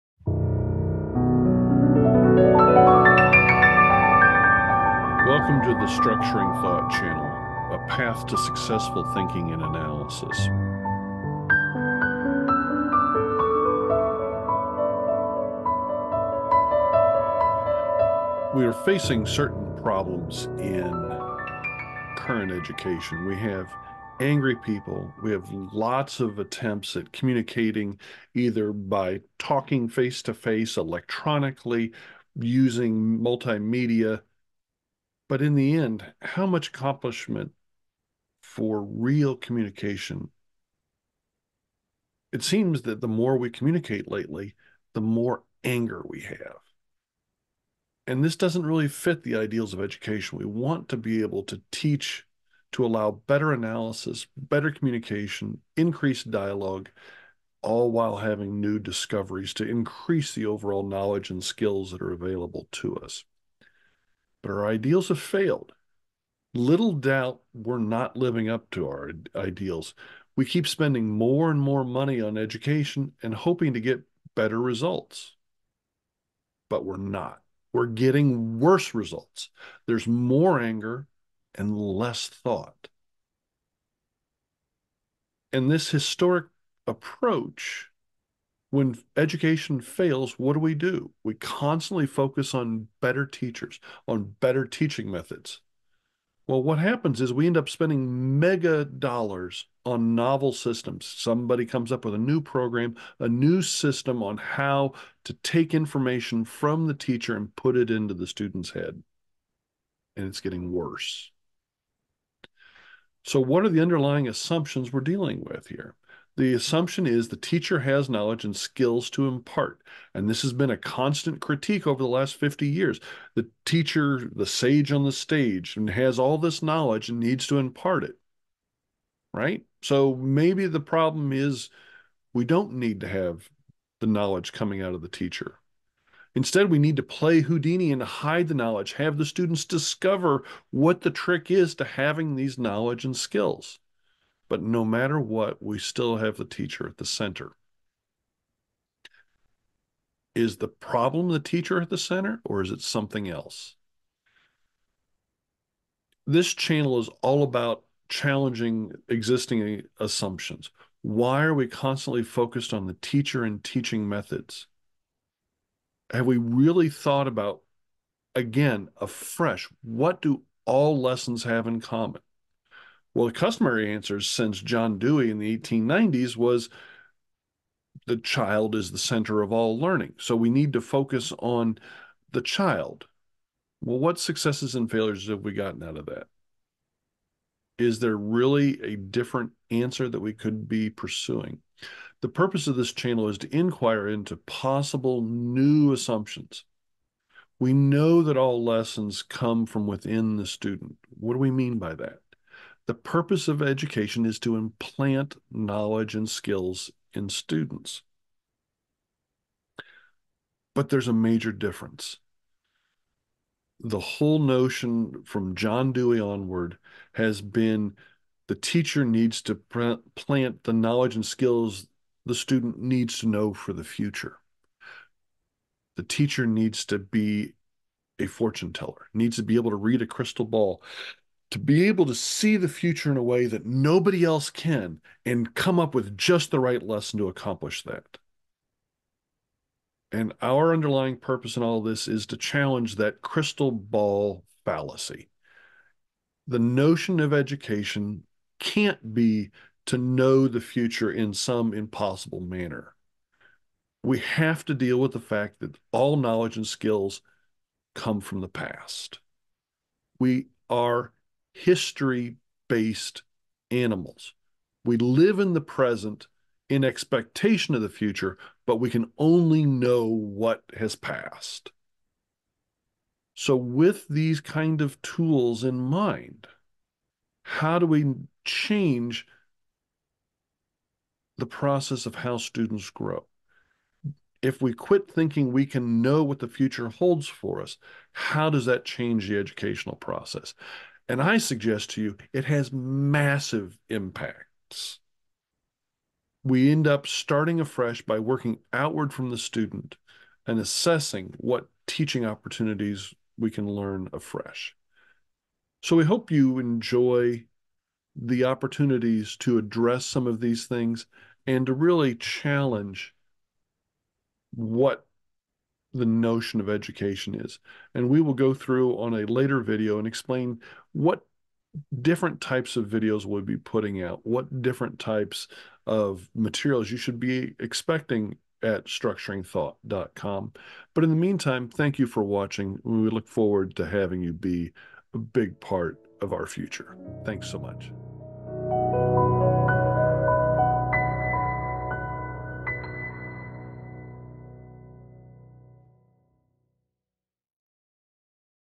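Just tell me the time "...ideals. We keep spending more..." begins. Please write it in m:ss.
1:09.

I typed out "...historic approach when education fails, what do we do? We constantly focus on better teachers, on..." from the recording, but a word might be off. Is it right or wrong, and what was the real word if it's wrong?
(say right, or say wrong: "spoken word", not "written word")
right.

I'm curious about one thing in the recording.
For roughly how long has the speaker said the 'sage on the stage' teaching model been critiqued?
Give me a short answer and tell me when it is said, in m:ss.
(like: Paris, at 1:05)
50 years, at 2:02.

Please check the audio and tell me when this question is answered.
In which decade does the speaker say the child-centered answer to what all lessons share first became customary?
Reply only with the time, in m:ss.
2:55.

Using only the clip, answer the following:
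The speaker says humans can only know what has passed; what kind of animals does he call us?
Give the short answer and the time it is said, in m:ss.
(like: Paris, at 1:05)
history based animals, at 4:21.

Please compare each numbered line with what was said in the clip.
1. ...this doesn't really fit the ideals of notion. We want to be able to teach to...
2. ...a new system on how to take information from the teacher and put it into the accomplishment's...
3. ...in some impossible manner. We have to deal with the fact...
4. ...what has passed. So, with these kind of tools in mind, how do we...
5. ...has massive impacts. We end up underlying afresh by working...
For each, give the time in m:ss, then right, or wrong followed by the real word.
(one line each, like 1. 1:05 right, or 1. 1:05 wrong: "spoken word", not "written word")
1. 0:48 wrong: "education", not "notion"
2. 1:43 wrong: "student", not "accomplishment"
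3. 4:11 right
4. 4:30 right
5. 4:52 wrong: "starting", not "underlying".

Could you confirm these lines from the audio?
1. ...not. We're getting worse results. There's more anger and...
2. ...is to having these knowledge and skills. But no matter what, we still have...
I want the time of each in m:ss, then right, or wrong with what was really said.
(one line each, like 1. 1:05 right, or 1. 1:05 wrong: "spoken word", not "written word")
1. 1:16 right
2. 2:21 right.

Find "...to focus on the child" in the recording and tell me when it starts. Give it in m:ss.
3:00.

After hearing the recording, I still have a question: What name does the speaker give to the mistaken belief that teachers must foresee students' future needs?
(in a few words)
crystal ball fallacy.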